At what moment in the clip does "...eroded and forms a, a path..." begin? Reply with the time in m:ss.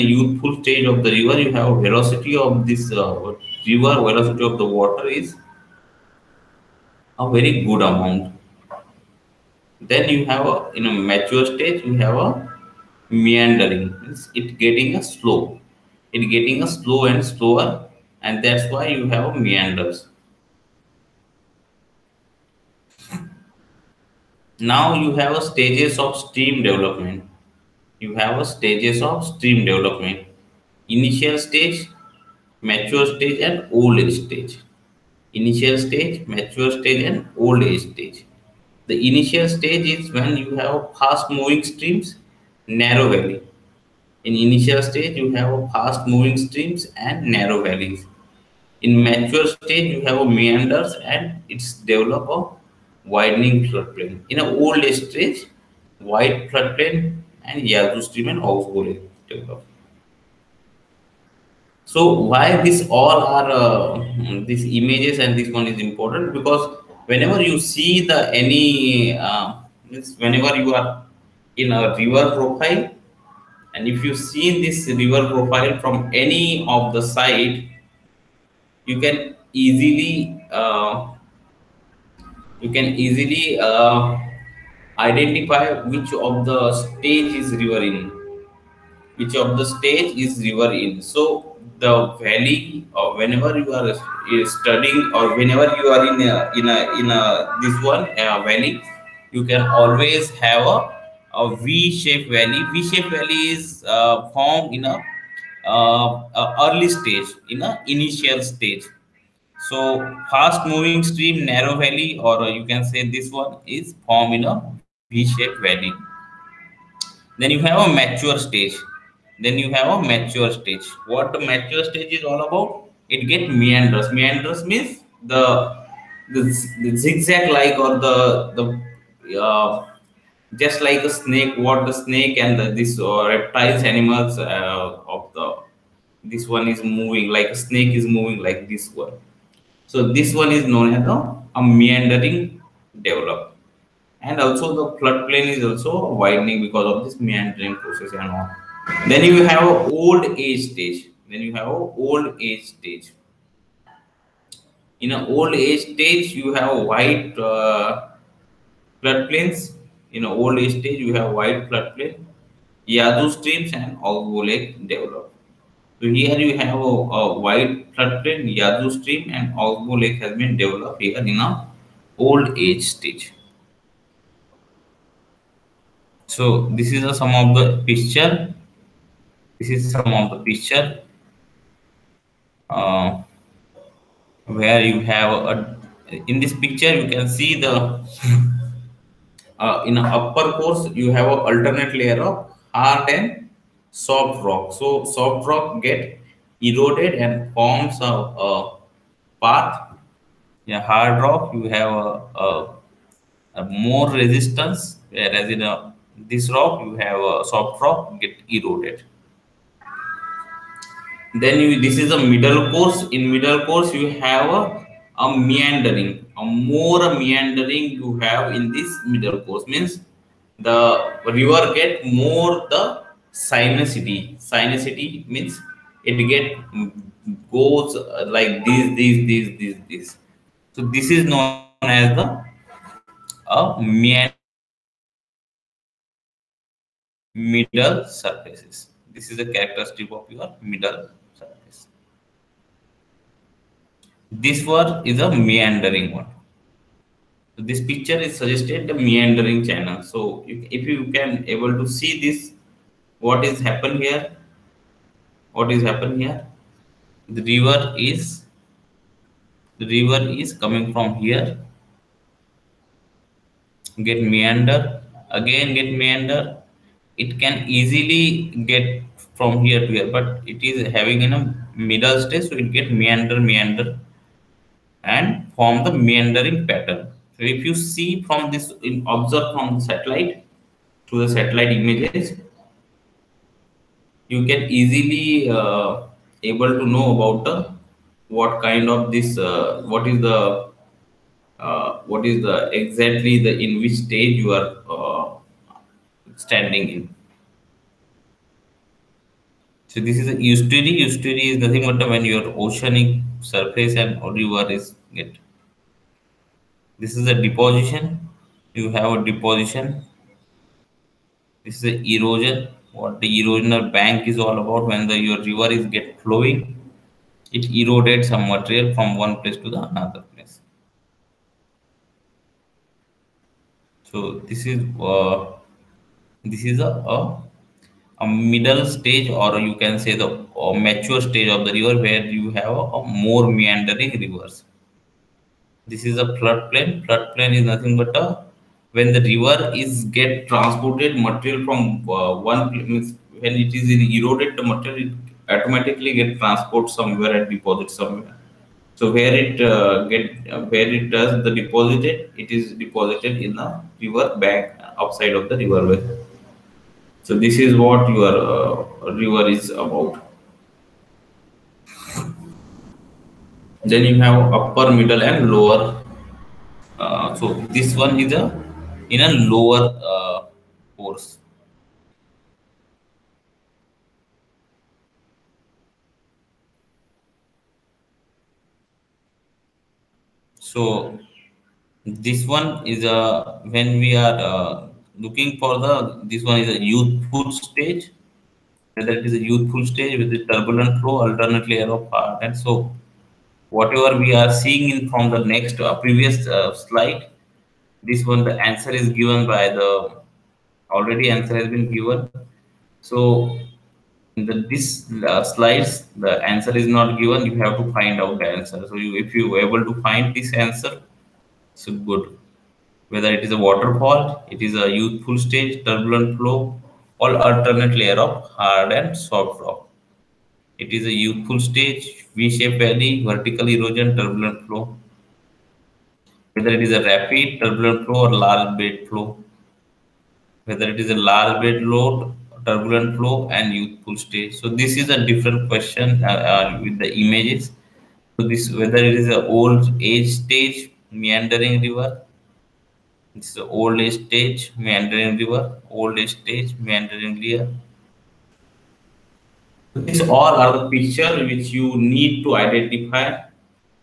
3:16.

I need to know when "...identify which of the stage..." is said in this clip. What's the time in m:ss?
1:25.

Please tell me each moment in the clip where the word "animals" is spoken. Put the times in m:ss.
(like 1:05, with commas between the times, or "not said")
2:13.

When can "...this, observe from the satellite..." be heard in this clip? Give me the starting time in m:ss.
4:38.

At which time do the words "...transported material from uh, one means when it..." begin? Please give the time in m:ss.
5:40.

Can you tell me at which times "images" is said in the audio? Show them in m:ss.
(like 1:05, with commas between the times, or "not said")
1:04, 4:41, 7:17.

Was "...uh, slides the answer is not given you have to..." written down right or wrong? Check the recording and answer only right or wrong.
right.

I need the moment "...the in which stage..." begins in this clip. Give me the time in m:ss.
4:53.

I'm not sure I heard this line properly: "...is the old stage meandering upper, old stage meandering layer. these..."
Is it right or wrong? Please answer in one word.
wrong.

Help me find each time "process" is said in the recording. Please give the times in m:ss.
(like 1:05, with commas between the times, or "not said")
2:27.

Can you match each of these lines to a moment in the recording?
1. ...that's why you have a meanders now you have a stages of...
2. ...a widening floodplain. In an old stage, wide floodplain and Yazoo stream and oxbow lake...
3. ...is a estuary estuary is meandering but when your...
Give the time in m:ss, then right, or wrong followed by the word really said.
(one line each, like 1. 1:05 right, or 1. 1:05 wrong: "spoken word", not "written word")
1. 0:18 right
2. 0:52 right
3. 5:00 wrong: "nothing", not "meandering".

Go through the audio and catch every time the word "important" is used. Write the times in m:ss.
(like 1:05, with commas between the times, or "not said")
1:05.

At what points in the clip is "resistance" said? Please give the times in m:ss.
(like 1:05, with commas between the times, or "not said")
3:24.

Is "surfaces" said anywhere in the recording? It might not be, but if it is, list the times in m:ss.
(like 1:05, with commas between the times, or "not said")
3:58, 5:03.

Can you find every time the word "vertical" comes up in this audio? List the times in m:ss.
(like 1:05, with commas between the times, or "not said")
7:03.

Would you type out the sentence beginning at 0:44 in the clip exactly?
In initial stage, you have fast moving streams and narrow valleys.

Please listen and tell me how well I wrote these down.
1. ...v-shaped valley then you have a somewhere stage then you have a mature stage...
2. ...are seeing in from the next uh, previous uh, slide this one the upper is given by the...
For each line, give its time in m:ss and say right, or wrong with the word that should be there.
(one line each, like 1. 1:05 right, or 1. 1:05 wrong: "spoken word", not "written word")
1. 1:55 wrong: "mature", not "somewhere"
2. 6:34 wrong: "answer", not "upper".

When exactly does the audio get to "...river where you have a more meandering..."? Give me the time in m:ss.
5:31.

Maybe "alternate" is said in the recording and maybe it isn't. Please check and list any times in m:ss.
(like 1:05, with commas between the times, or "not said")
3:11, 6:31, 6:57.